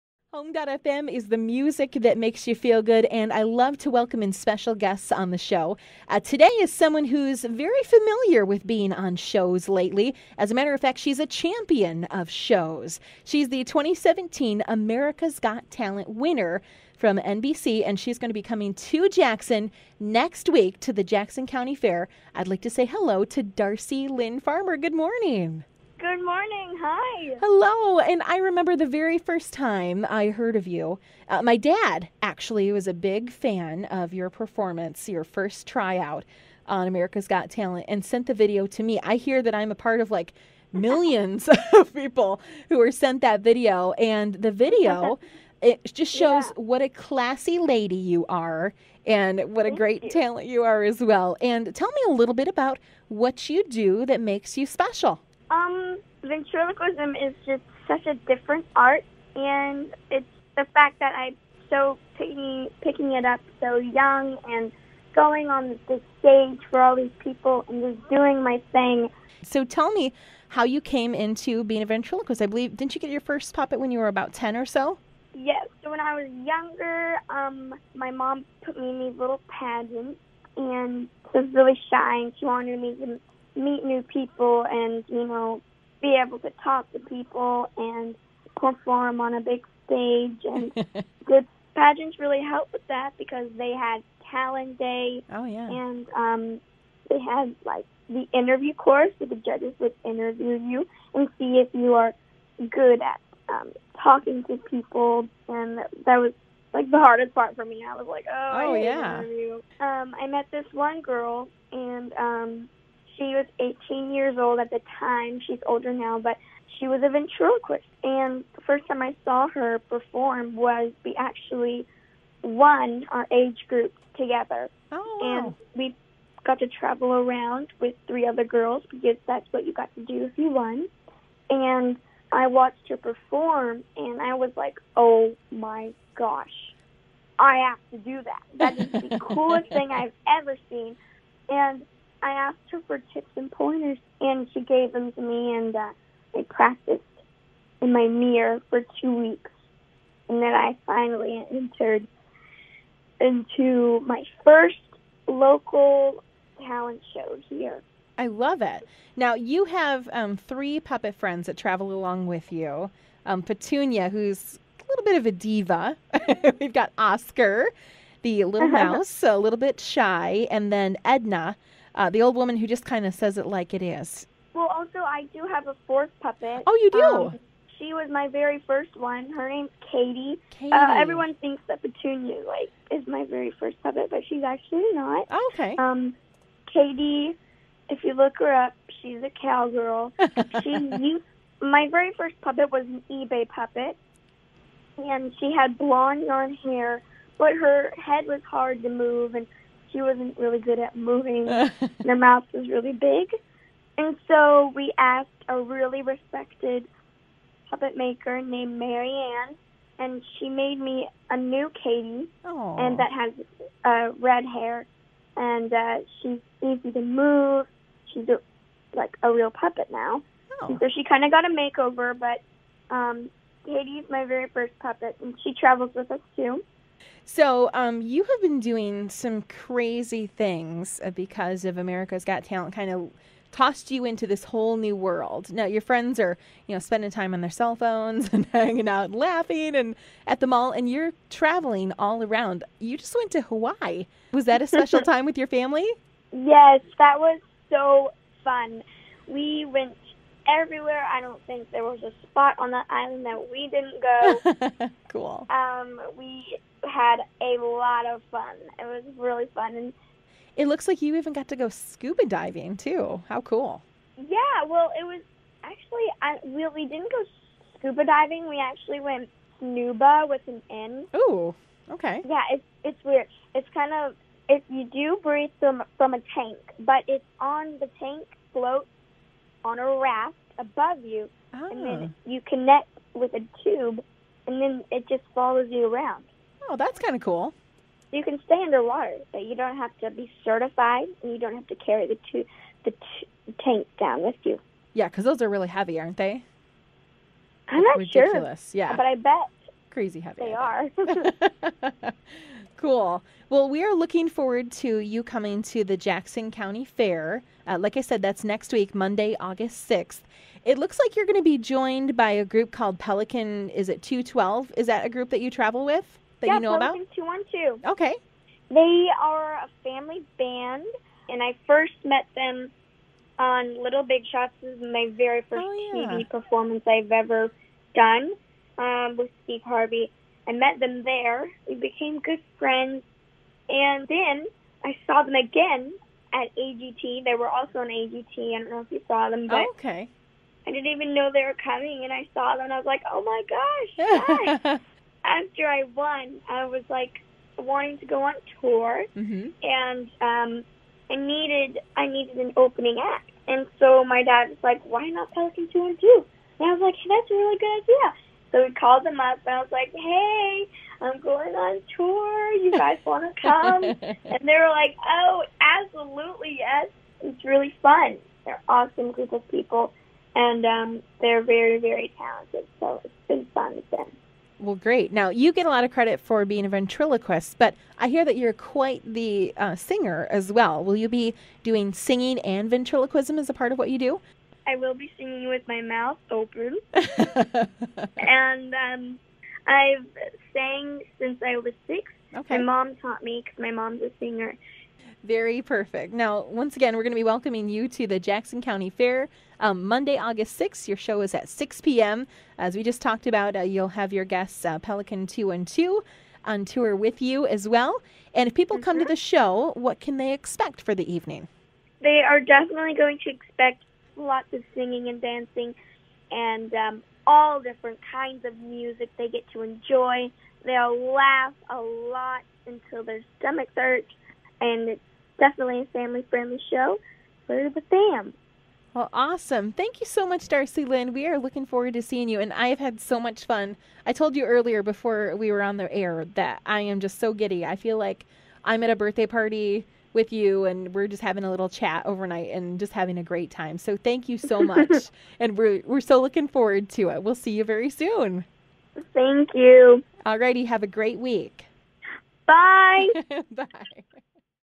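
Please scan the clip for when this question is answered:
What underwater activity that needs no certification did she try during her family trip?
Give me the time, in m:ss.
4:29.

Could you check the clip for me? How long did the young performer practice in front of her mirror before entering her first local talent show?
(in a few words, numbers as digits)
2 weeks.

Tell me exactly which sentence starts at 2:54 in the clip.
Well, also, I do have a fourth puppet.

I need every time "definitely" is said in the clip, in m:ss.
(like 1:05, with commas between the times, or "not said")
6:52, 7:05.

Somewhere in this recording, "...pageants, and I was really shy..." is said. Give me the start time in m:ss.
1:19.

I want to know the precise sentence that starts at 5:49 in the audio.
and um, I needed I needed an opening act, and so my dad was like, why not Pelican Two and Two?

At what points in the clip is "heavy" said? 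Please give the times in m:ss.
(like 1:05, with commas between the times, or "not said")
4:55, 5:00.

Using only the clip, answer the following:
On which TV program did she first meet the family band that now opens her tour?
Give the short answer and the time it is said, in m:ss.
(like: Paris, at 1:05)
Little Big Shots, at 5:23.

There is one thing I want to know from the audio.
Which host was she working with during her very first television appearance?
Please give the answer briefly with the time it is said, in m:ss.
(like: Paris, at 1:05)
Steve Harvey, at 5:29.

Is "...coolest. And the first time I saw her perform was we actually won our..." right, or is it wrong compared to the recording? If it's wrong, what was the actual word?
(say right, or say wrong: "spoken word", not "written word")
wrong: "ventriloquist", not "coolest".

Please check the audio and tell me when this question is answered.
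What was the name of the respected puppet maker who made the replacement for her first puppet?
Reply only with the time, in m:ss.
3:28.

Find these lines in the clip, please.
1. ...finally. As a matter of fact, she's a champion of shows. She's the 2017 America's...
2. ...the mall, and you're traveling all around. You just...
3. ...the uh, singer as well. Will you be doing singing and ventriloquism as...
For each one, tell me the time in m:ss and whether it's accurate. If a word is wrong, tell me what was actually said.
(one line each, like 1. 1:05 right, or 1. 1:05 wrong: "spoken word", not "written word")
1. 0:09 wrong: "lately", not "finally"
2. 4:00 right
3. 6:19 right.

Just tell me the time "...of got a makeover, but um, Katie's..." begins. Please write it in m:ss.
3:41.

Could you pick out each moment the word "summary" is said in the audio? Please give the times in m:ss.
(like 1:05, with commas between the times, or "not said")
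not said.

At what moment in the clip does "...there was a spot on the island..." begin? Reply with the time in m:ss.
4:11.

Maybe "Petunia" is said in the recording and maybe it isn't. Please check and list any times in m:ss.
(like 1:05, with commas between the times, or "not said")
2:43, 3:01.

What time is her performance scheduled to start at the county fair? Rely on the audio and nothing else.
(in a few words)
6 p.m.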